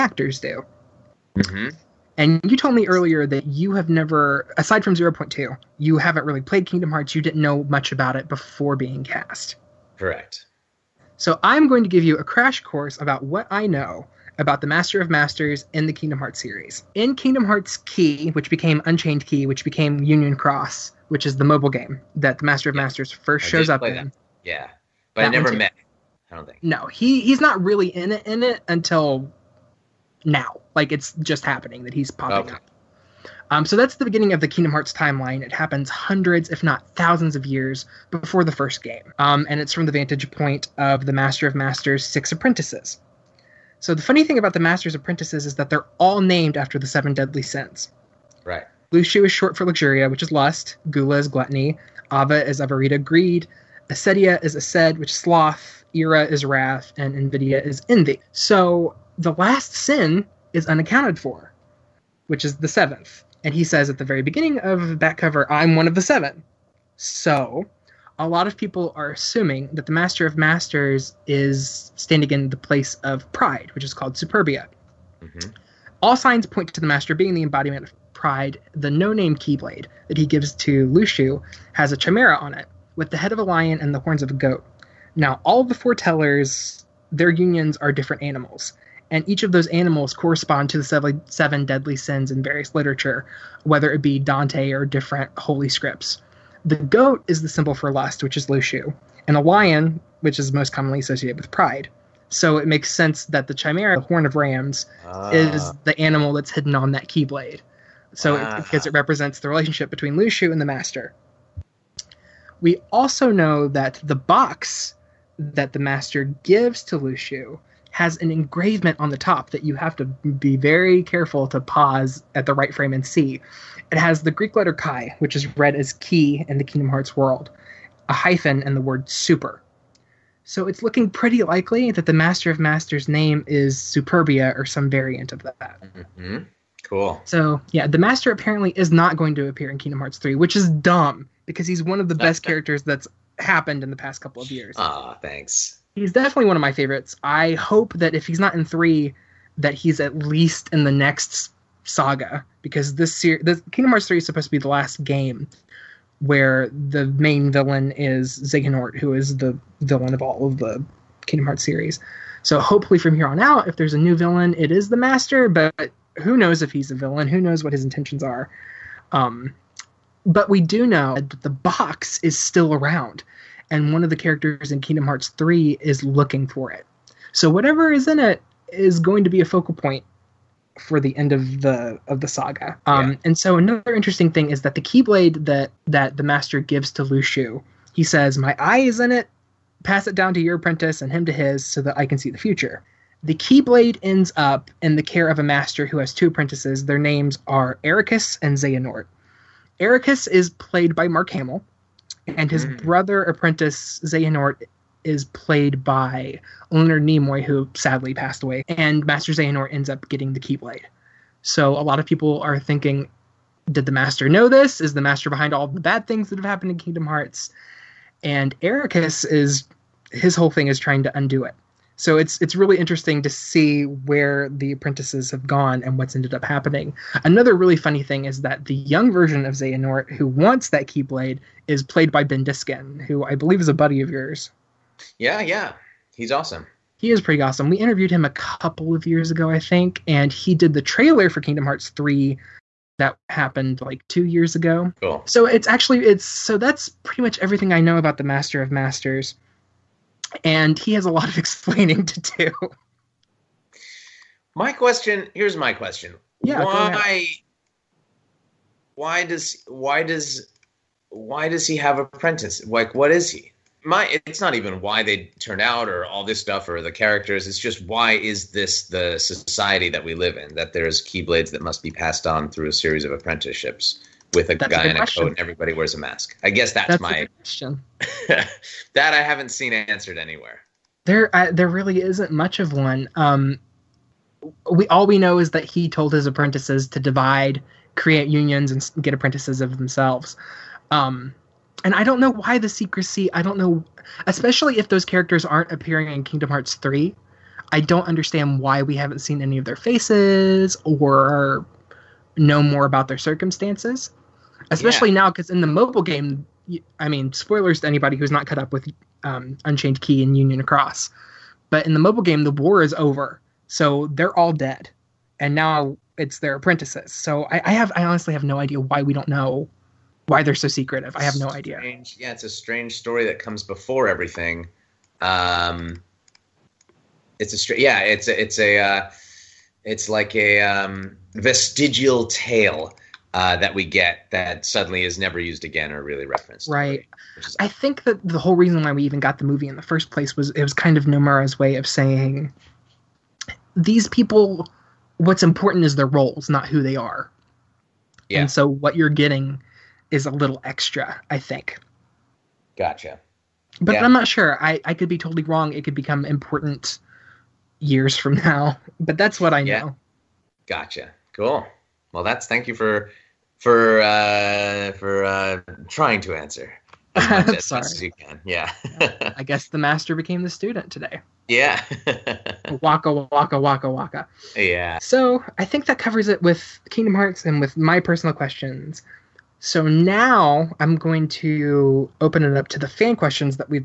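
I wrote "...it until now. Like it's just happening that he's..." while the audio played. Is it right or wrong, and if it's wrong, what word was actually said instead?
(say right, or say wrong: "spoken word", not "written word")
right.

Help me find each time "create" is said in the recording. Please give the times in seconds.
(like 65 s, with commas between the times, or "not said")
287 s.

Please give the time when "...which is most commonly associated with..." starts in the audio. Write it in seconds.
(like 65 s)
100 s.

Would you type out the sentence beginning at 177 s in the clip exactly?
So whatever is in it is going to be a focal point for the end of the of the saga.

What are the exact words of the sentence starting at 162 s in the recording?
So hopefully from here on out, if there's a new villain, it is the Master.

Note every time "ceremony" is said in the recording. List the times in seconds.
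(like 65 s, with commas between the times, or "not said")
not said.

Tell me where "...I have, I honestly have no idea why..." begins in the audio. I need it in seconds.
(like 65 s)
317 s.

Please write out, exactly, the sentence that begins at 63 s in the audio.
And he says at the very beginning of back cover, I'm one of the seven.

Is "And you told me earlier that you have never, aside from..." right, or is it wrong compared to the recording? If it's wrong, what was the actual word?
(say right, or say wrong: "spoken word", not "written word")
right.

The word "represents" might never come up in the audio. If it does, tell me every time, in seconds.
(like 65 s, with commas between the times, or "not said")
108 s.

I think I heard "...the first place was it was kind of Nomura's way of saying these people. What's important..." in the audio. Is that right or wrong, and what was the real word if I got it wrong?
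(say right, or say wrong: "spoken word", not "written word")
right.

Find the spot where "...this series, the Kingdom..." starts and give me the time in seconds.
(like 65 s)
152 s.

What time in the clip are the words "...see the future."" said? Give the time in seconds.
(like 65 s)
192 s.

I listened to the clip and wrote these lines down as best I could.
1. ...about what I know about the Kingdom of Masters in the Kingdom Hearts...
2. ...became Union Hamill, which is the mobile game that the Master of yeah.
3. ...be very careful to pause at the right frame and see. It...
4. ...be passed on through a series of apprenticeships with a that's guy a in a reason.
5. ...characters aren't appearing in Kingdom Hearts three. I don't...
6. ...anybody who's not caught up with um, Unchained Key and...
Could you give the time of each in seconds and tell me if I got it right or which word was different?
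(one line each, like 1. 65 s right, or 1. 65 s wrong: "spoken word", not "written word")
1. 13 s wrong: "Master", not "Kingdom"
2. 19 s wrong: "Cross", not "Hamill"
3. 120 s right
4. 271 s wrong: "question", not "reason"
5. 295 s right
6. 307 s right.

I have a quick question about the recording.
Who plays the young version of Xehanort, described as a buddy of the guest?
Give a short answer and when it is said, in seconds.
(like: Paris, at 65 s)
Ben Diskin, at 232 s.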